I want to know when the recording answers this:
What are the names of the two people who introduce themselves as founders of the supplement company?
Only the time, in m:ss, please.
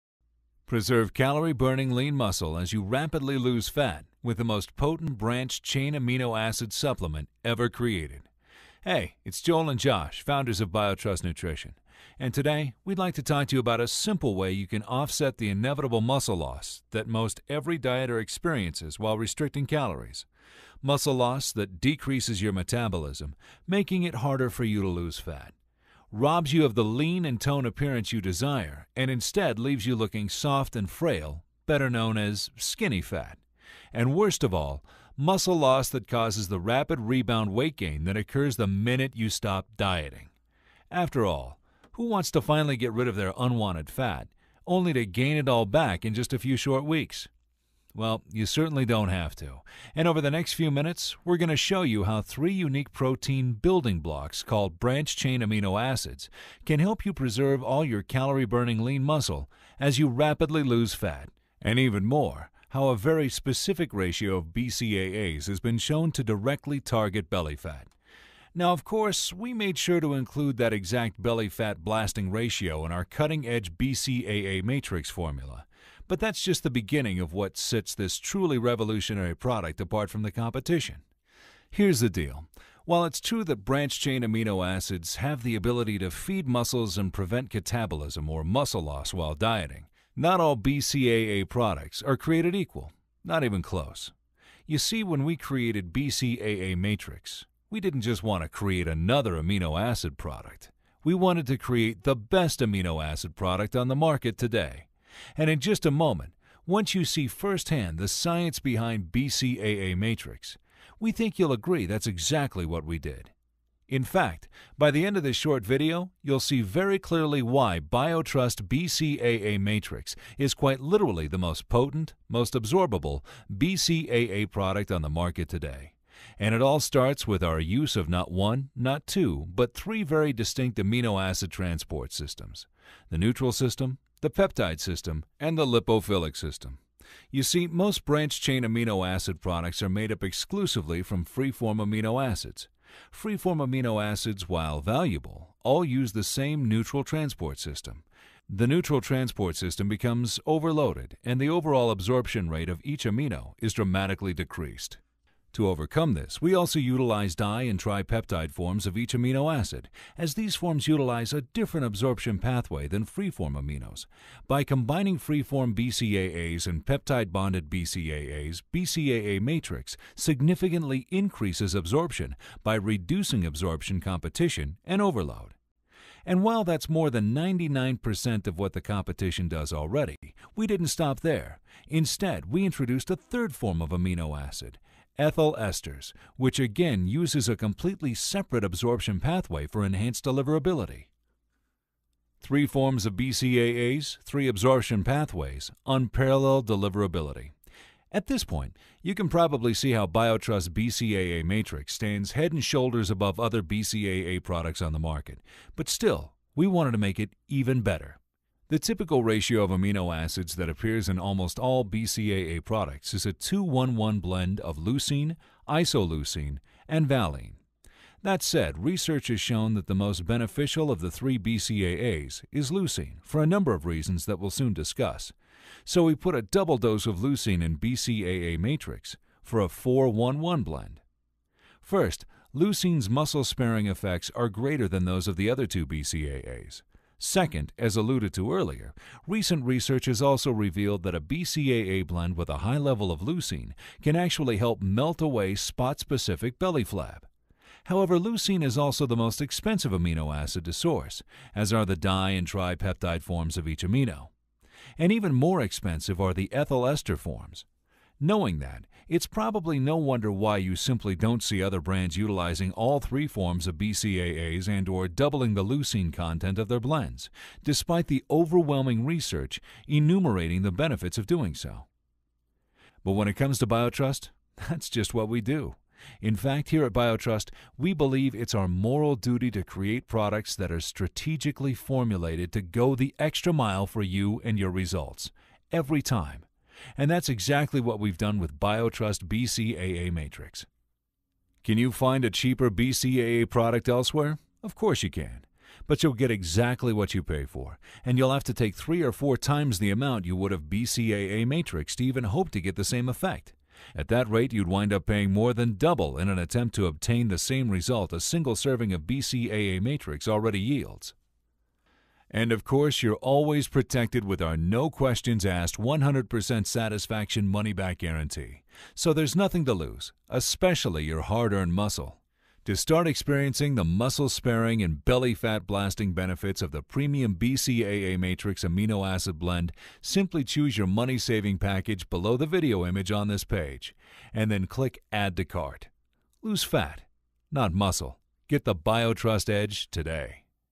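0:09.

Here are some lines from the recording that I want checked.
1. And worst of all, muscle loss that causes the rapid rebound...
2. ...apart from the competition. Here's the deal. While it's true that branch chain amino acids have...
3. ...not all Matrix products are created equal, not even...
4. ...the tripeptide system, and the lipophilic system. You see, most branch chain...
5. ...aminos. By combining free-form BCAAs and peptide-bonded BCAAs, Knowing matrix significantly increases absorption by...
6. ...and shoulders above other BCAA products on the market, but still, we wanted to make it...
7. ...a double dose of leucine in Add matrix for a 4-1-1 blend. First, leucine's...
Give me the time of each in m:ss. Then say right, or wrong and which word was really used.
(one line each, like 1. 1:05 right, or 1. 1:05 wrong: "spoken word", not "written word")
1. 0:33 right
2. 1:19 right
3. 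1:30 wrong: "BCAA", not "Matrix"
4. 2:14 wrong: "peptide", not "tripeptide"
5. 2:43 wrong: "BCAA", not "Knowing"
6. 3:22 right
7. 3:46 wrong: "BCAA", not "Add".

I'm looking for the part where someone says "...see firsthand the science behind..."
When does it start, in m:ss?
1:47.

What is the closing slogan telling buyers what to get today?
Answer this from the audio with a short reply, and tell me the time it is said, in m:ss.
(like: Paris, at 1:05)
the BioTrust Edge, at 5:38.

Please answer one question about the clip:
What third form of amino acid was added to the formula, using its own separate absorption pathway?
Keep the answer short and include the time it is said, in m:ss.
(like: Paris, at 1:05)
ethyl esters, at 3:05.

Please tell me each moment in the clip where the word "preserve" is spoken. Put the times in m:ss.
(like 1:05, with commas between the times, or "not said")
0:00, 0:57.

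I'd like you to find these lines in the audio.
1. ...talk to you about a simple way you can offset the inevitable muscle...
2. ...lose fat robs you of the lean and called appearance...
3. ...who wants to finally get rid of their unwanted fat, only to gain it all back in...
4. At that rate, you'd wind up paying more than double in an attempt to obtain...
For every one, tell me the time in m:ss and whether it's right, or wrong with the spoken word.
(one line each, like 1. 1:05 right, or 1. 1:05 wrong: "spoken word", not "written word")
1. 0:13 right
2. 0:24 wrong: "toned", not "called"
3. 0:41 right
4. 5:03 right.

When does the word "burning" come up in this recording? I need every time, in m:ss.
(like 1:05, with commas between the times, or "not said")
0:01, 0:58.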